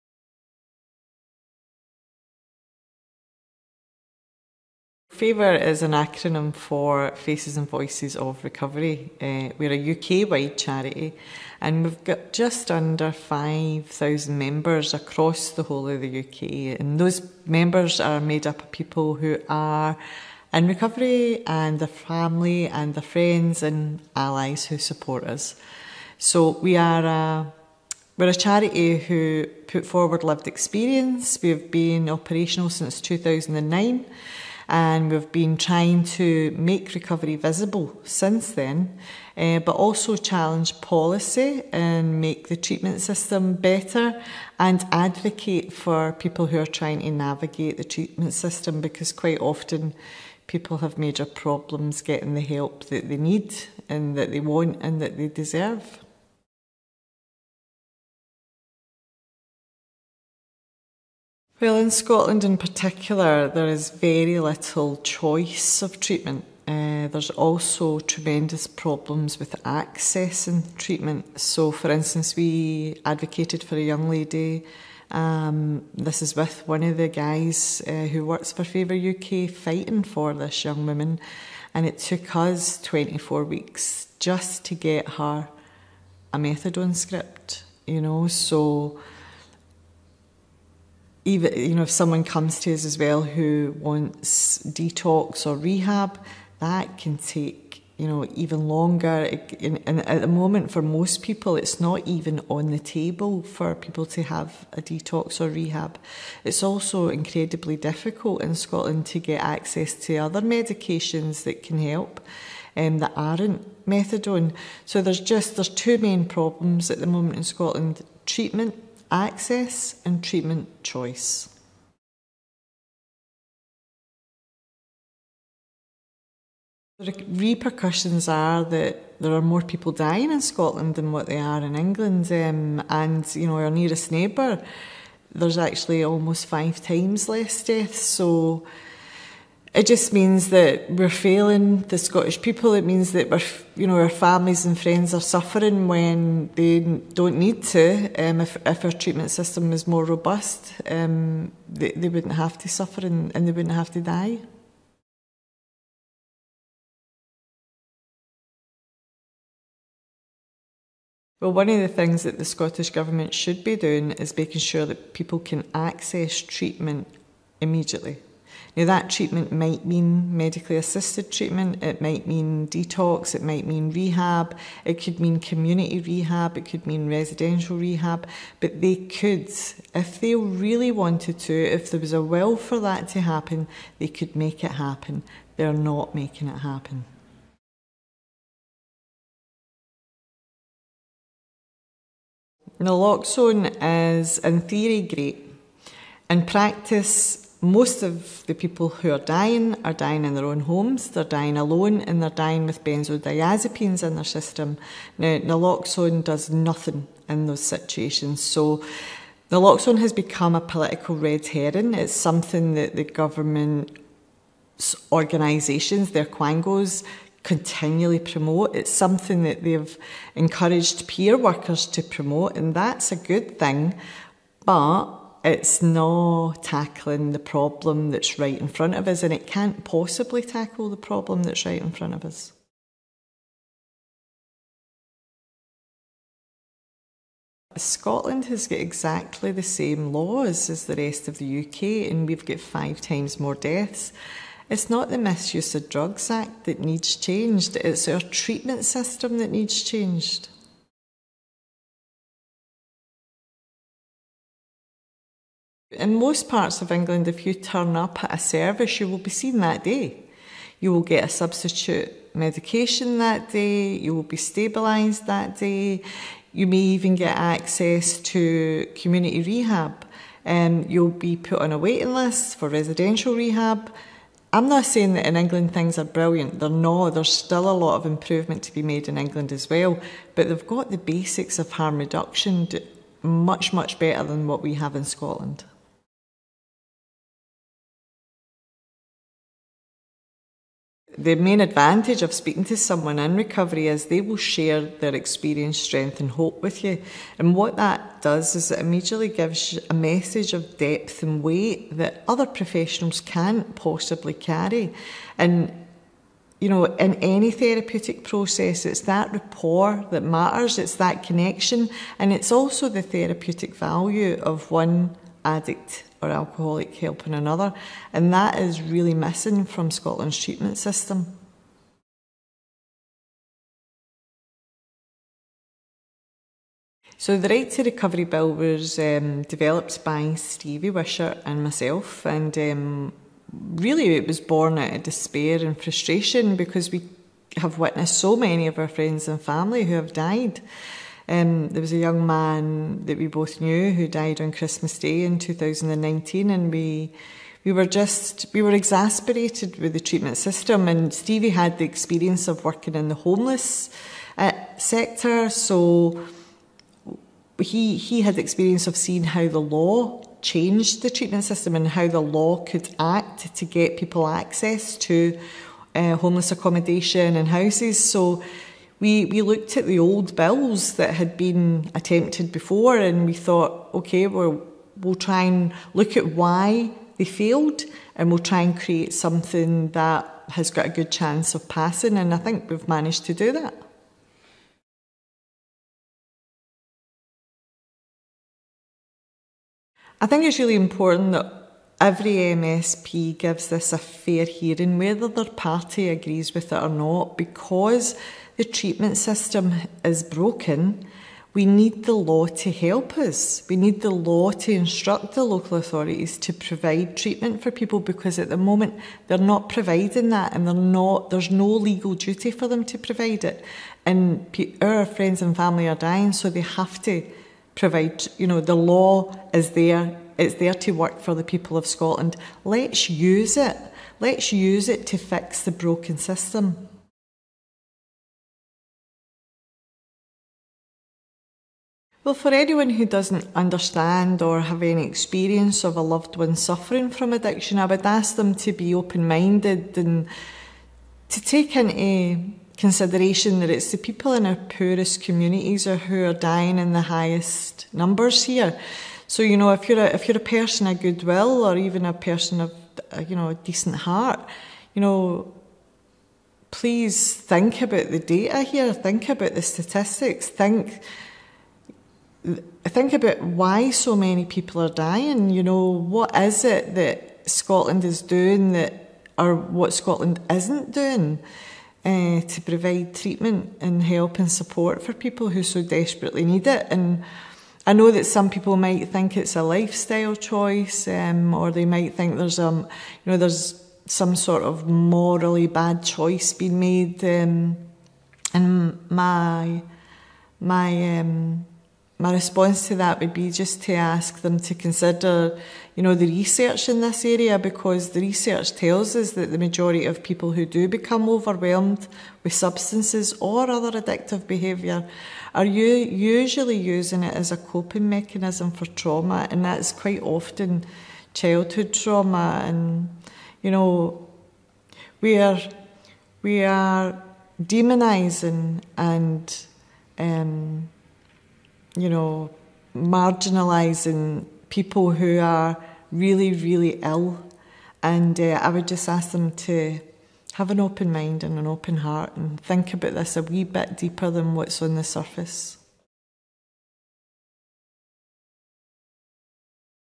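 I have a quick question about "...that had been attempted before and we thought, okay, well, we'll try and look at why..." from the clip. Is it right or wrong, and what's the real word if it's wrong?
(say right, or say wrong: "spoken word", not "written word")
right.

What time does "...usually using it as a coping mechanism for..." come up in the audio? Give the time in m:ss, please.
8:25.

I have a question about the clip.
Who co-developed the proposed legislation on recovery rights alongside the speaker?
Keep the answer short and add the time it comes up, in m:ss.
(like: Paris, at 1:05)
Stevie Wishart, at 5:30.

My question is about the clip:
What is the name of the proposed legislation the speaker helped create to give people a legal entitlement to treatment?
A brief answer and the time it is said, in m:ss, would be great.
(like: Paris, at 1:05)
Right to Recovery Bill, at 5:27.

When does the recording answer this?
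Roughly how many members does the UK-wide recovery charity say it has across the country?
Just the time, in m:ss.
0:12.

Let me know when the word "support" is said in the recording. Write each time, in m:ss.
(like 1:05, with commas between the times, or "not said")
0:24, 7:54.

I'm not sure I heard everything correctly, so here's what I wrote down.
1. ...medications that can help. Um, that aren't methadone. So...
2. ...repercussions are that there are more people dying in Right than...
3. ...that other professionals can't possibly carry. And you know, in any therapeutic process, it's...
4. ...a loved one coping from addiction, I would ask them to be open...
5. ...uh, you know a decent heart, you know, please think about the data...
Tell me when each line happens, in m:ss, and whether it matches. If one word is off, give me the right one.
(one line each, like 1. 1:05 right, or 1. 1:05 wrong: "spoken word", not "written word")
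1. 1:50 right
2. 2:07 wrong: "Scotland", not "Right"
3. 5:01 right
4. 7:15 wrong: "suffering", not "coping"
5. 7:33 right.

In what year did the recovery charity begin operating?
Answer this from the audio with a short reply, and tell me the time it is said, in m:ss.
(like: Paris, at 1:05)
2009, at 0:33.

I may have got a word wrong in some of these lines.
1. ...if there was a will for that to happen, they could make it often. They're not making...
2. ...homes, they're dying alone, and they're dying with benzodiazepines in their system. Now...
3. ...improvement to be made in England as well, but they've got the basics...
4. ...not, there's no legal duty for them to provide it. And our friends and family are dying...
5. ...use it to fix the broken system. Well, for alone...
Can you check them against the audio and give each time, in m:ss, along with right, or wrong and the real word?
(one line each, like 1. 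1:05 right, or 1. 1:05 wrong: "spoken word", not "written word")
1. 3:01 wrong: "happen", not "often"
2. 3:20 right
3. 4:38 right
4. 6:50 right
5. 7:04 wrong: "anyone", not "alone".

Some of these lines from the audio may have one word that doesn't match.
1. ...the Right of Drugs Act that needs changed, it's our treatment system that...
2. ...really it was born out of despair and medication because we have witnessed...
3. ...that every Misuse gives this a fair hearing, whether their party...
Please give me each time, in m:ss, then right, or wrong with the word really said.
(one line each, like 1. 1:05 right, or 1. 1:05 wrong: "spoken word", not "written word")
1. 4:05 wrong: "Misuse", not "Right"
2. 5:33 wrong: "frustration", not "medication"
3. 6:31 wrong: "MSP", not "Misuse".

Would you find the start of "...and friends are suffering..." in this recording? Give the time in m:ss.
2:24.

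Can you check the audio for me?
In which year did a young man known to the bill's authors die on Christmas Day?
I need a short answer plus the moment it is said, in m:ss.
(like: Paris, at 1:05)
2019, at 5:45.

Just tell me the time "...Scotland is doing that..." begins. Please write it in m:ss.
7:47.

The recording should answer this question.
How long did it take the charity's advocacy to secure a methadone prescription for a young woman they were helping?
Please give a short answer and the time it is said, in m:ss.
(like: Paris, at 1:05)
24 weeks, at 1:22.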